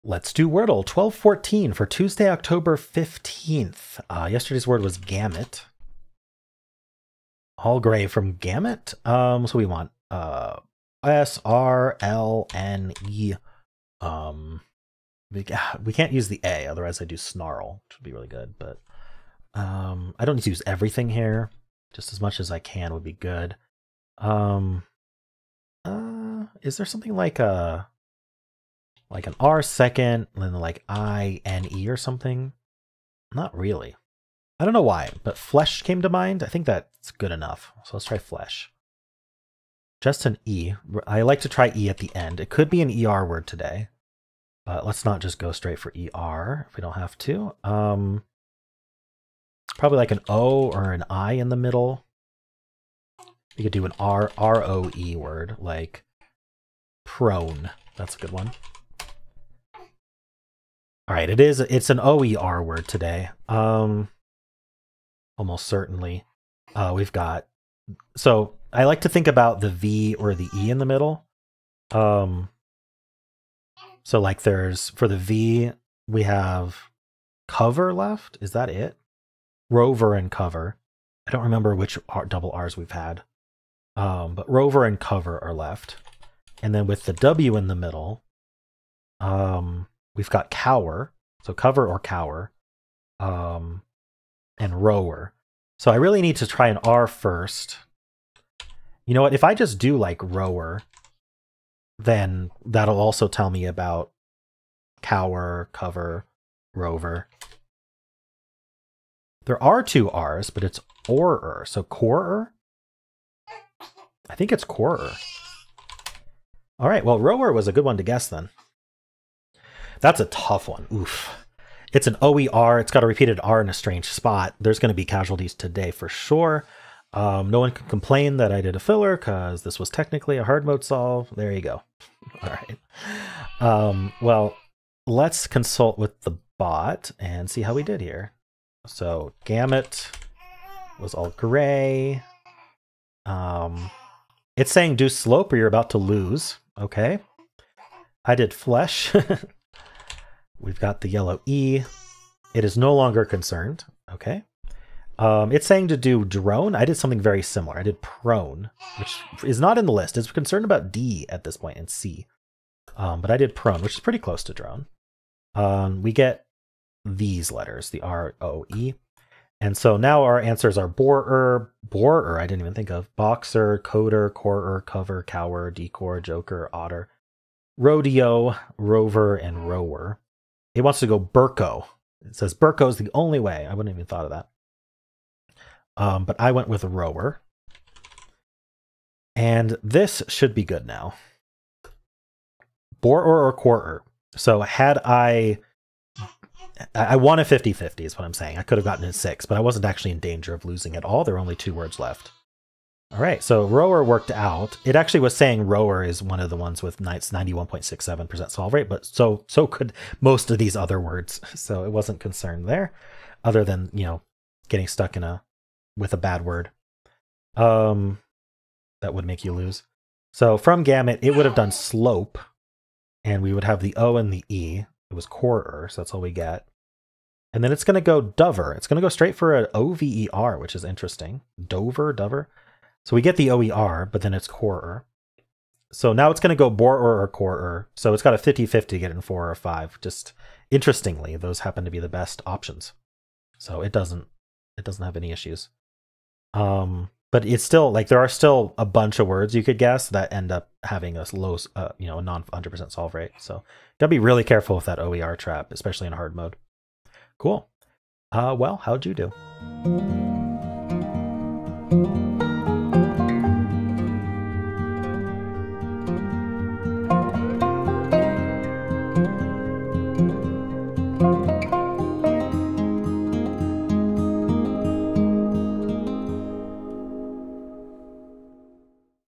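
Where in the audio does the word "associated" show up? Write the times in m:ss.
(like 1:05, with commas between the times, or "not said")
not said.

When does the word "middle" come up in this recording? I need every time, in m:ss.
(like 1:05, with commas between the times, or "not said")
0:51, 1:10, 1:27.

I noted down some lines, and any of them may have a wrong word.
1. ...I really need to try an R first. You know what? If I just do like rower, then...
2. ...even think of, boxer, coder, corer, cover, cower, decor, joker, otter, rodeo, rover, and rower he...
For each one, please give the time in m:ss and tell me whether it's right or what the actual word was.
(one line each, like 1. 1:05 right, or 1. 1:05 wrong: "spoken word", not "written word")
1. 1:35 right
2. 2:52 right.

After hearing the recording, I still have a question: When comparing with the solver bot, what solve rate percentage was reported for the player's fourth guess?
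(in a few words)
91.67%.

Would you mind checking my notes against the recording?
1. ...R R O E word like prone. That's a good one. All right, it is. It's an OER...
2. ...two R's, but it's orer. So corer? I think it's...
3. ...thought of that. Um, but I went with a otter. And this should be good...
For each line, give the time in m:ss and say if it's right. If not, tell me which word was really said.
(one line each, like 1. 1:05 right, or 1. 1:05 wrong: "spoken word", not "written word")
1. 0:53 right
2. 1:49 right
3. 3:04 wrong: "rower", not "otter".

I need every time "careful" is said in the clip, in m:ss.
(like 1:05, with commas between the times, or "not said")
4:14.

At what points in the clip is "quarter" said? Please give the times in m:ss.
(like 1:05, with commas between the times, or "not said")
3:13, 3:45.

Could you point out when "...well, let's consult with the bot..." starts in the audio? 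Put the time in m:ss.
2:14.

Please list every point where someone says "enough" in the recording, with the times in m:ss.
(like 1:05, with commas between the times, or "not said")
0:37.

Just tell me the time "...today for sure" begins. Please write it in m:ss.
2:05.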